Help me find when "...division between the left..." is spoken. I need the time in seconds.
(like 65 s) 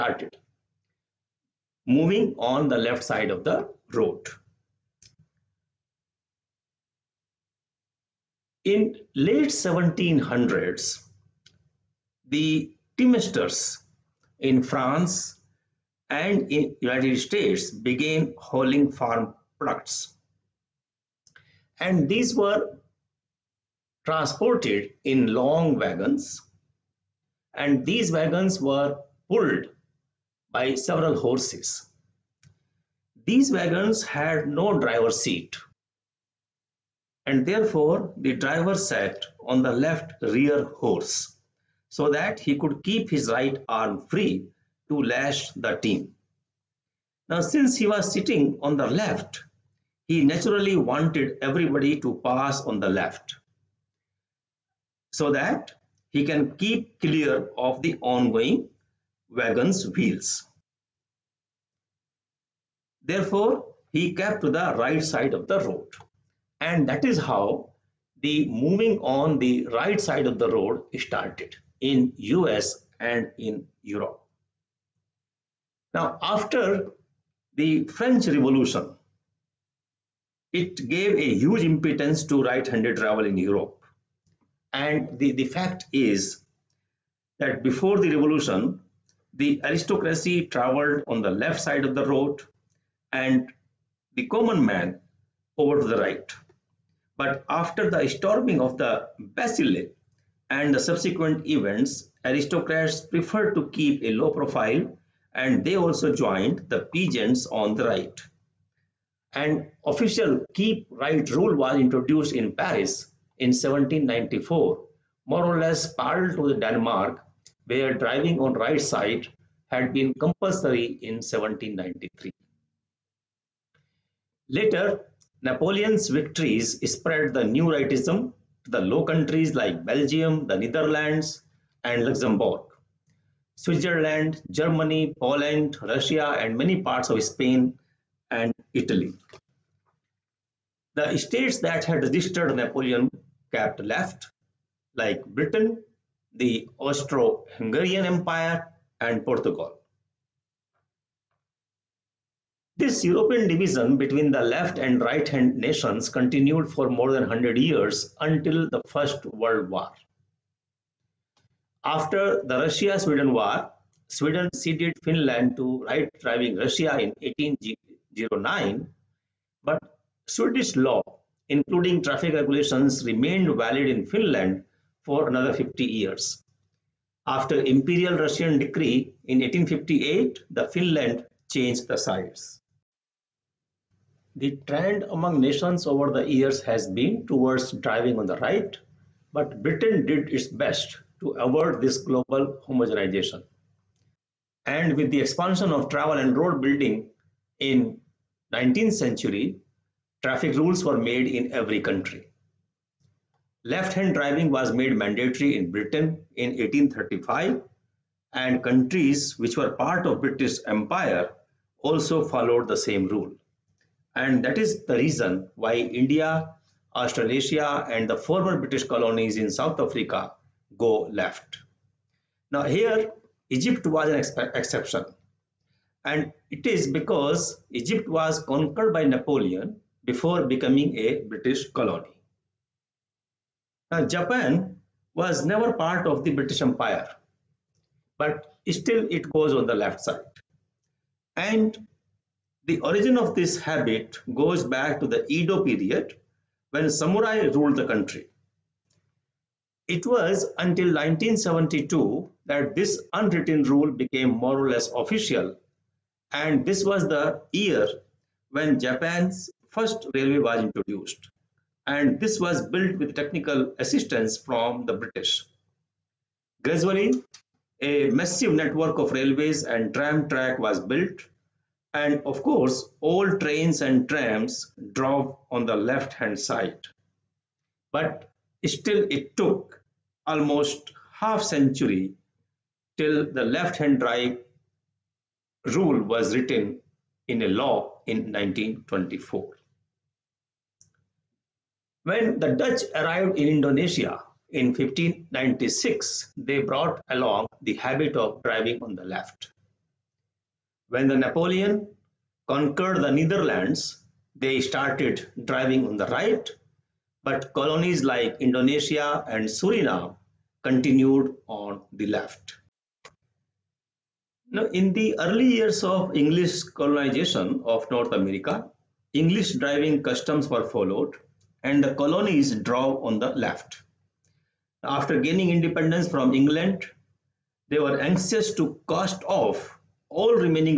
153 s.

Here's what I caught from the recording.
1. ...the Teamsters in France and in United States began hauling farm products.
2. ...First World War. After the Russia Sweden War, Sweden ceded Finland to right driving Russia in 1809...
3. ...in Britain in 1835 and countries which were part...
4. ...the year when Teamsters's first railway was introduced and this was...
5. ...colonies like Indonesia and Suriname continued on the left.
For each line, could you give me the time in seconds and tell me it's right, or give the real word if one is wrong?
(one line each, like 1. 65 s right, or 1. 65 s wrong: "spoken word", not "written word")
1. 12 s right
2. 158 s right
3. 205 s right
4. 257 s wrong: "Japan", not "Teamsters"
5. 307 s right.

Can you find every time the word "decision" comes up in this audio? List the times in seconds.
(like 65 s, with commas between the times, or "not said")
not said.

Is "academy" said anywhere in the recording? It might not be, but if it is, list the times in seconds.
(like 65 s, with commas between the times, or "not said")
not said.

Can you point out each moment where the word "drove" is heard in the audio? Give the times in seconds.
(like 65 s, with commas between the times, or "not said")
274 s, 322 s.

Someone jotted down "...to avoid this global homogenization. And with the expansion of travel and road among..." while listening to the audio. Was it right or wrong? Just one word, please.
wrong.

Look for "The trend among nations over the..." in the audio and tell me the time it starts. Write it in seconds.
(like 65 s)
184 s.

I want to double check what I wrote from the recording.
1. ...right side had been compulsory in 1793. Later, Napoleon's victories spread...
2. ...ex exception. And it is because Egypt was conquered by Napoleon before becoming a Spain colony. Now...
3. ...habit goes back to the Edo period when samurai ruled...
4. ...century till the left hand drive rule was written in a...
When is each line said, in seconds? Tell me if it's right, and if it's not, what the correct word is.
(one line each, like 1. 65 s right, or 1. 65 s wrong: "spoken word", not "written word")
1. 118 s right
2. 224 s wrong: "British", not "Spain"
3. 243 s right
4. 281 s right.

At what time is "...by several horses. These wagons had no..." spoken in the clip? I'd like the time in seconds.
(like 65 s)
30 s.